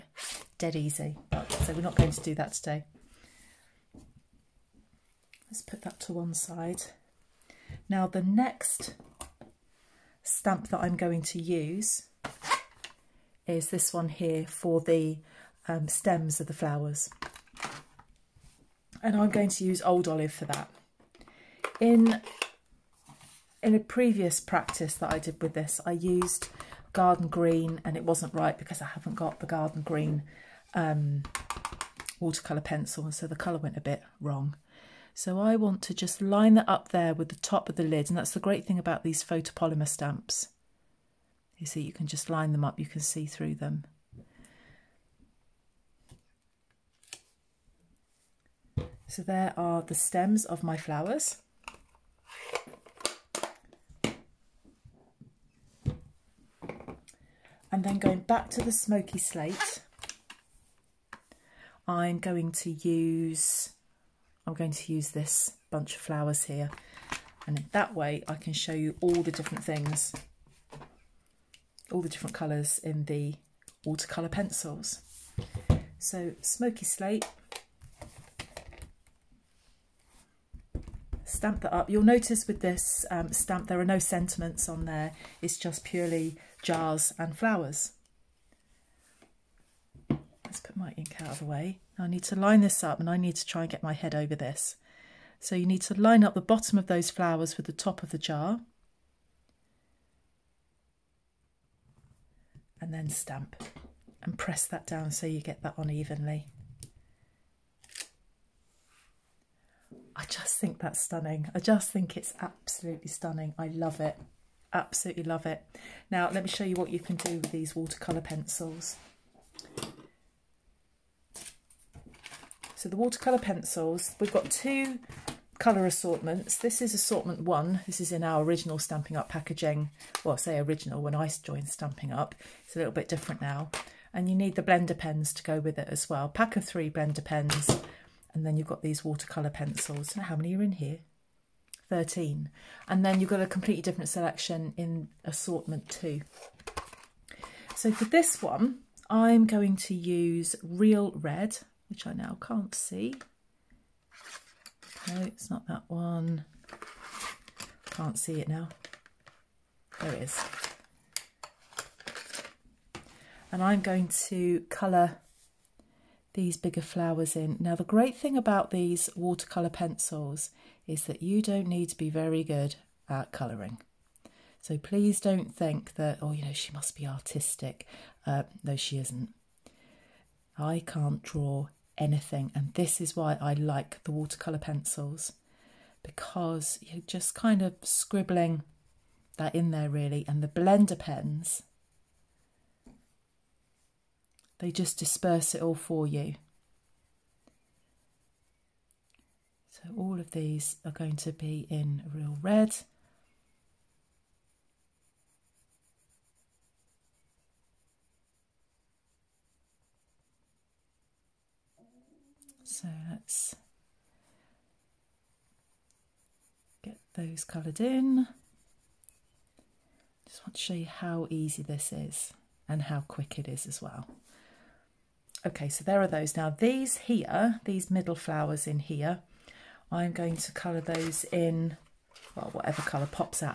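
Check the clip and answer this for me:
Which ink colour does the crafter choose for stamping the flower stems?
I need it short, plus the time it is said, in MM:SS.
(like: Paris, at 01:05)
Old Olive, at 00:19.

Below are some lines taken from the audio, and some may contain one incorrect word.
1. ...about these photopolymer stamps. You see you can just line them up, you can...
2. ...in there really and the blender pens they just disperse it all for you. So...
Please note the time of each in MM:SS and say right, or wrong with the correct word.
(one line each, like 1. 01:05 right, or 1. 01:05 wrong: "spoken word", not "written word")
1. 00:38 right
2. 03:09 right.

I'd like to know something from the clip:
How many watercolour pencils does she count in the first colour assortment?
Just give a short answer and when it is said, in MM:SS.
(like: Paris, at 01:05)
13, at 02:21.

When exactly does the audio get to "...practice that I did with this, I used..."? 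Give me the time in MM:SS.
00:24.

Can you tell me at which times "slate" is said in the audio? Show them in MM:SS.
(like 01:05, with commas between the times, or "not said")
00:59, 01:16.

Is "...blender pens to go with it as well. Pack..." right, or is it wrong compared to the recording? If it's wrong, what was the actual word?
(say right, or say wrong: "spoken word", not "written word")
right.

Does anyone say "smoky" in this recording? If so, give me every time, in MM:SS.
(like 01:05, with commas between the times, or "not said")
00:58, 01:16.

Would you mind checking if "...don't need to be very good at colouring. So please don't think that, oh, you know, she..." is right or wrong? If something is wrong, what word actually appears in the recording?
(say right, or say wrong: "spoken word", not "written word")
right.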